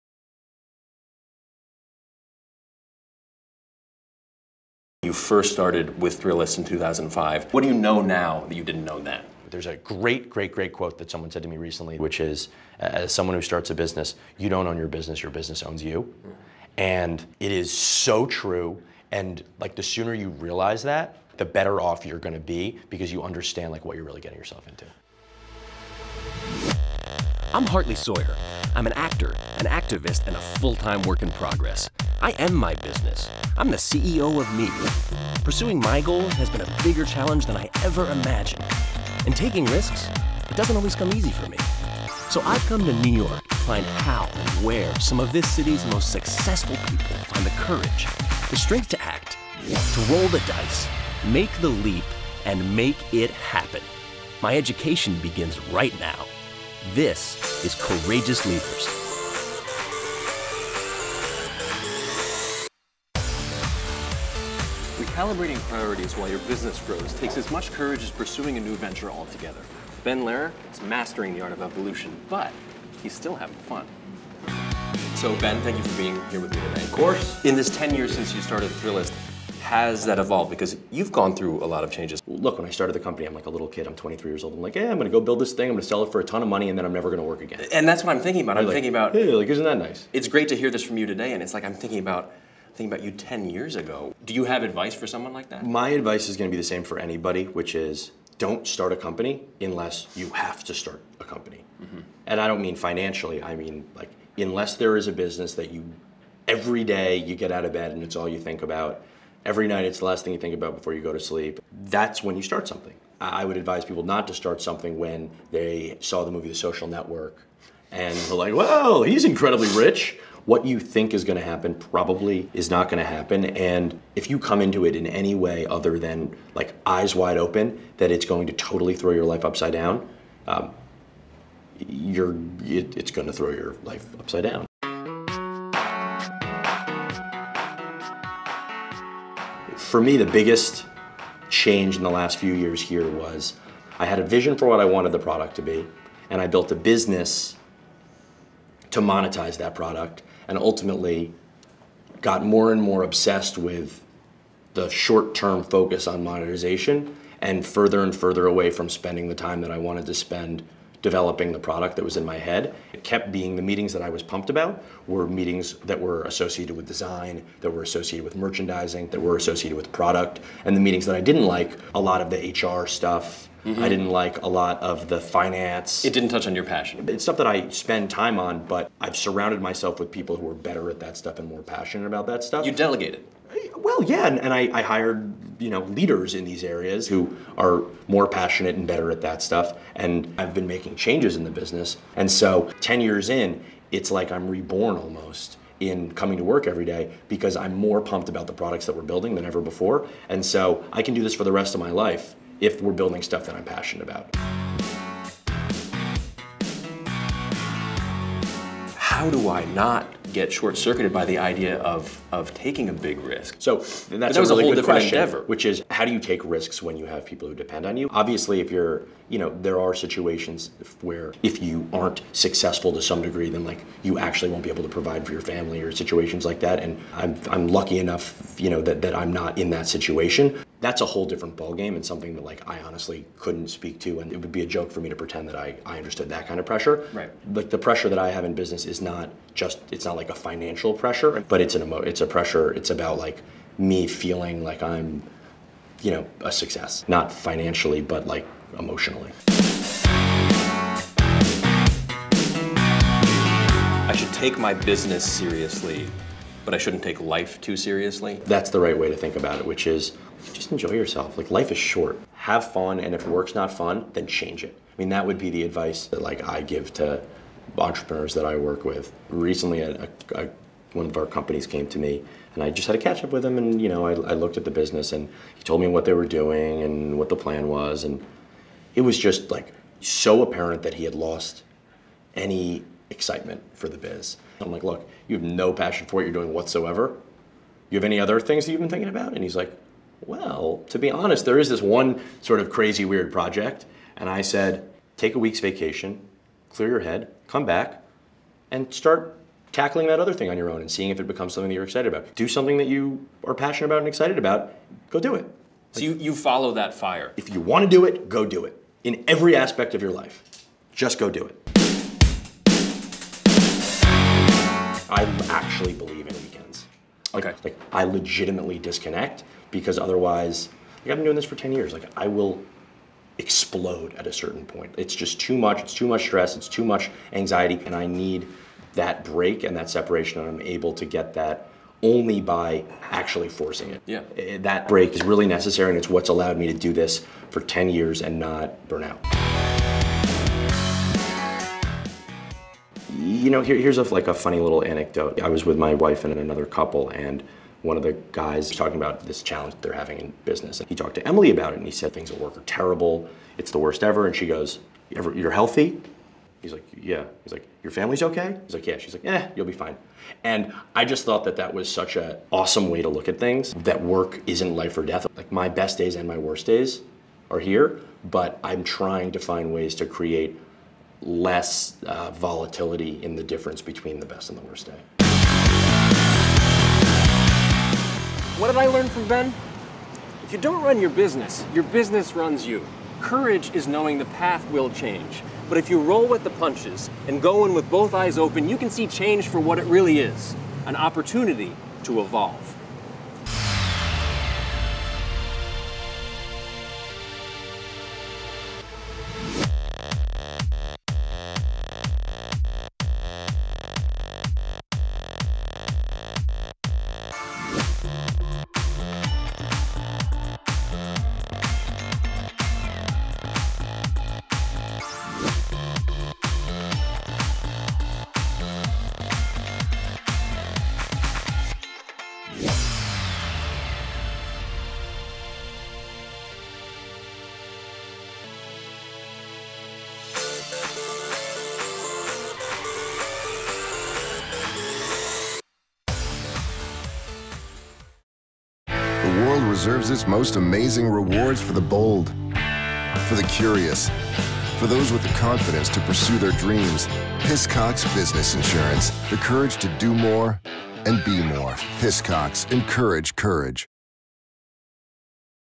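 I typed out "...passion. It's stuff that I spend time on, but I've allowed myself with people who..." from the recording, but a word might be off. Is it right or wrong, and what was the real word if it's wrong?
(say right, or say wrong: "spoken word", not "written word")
wrong: "surrounded", not "allowed".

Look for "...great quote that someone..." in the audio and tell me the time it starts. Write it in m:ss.
0:10.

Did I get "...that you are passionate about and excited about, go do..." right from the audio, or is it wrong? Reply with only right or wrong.
right.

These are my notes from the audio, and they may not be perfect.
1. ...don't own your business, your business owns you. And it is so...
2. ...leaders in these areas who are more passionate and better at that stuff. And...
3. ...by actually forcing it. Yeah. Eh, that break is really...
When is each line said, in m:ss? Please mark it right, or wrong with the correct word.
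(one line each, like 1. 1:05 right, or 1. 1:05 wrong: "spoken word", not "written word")
1. 0:14 right
2. 3:05 right
3. 5:32 right.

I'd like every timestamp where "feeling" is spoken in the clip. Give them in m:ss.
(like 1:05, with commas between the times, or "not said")
4:04.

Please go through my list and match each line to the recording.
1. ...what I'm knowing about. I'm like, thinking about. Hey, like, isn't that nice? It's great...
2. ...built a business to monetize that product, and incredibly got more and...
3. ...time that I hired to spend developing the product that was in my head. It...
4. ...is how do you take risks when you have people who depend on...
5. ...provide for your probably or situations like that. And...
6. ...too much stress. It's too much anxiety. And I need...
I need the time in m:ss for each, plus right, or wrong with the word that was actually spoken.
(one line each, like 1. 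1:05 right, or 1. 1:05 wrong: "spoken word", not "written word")
1. 1:28 wrong: "thinking", not "knowing"
2. 2:26 wrong: "ultimately", not "incredibly"
3. 2:39 wrong: "wanted", not "hired"
4. 3:35 right
5. 3:44 wrong: "family", not "probably"
6. 5:25 right.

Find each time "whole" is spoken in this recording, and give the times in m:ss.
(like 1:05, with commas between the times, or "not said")
3:34, 3:51.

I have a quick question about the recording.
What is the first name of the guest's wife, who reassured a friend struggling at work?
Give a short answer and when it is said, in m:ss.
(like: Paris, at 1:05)
Emily, at 5:51.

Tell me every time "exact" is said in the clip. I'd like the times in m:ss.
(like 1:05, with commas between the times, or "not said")
not said.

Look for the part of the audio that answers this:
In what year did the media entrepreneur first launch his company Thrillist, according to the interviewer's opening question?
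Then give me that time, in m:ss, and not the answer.
0:06.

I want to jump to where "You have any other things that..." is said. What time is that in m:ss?
4:47.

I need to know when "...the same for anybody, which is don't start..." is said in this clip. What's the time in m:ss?
1:36.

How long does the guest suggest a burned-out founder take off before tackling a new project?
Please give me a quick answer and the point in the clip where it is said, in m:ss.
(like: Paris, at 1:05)
A week, at 4:55.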